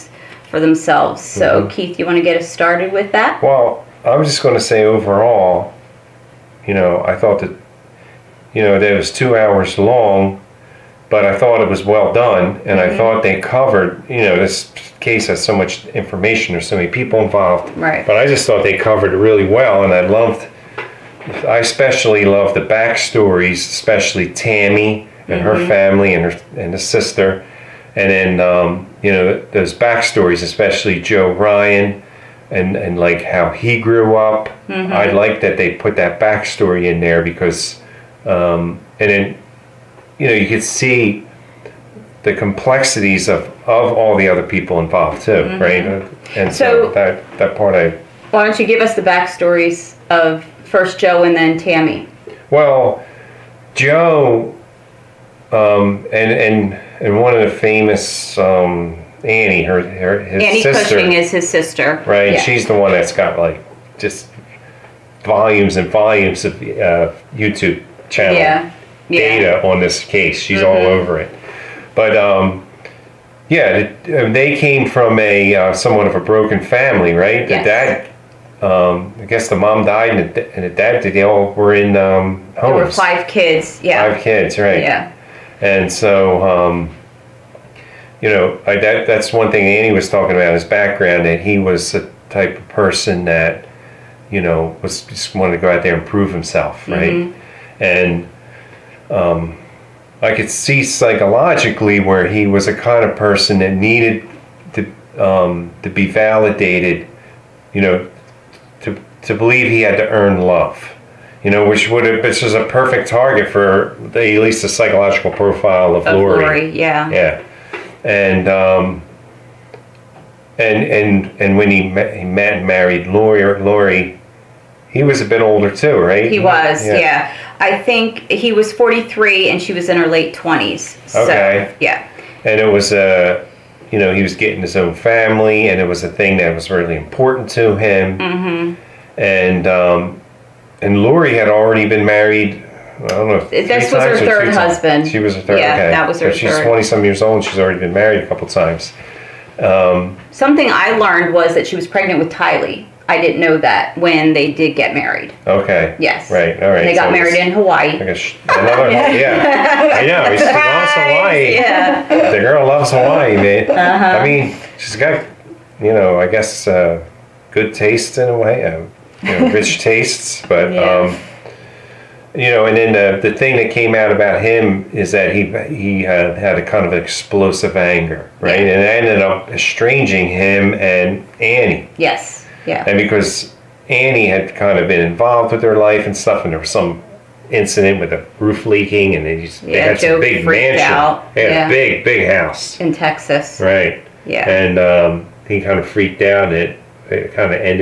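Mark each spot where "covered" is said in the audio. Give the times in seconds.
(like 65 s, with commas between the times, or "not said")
13 s, 18 s.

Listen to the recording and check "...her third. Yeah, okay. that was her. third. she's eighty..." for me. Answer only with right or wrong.
wrong.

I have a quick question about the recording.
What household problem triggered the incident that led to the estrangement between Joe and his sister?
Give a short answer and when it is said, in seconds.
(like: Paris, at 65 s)
roof leaking, at 188 s.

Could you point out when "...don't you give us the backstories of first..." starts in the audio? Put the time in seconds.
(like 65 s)
48 s.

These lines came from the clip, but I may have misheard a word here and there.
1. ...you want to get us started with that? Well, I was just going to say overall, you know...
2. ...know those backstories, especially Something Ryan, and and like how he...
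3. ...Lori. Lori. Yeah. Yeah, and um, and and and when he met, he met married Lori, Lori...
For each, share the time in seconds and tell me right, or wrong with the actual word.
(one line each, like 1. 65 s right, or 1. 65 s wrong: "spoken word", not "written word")
1. 1 s right
2. 29 s wrong: "Joe", not "Something"
3. 116 s right.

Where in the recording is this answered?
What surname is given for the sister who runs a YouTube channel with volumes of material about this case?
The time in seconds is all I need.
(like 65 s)
60 s.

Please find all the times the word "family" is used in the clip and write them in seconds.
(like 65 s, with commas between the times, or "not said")
25 s, 76 s, 134 s.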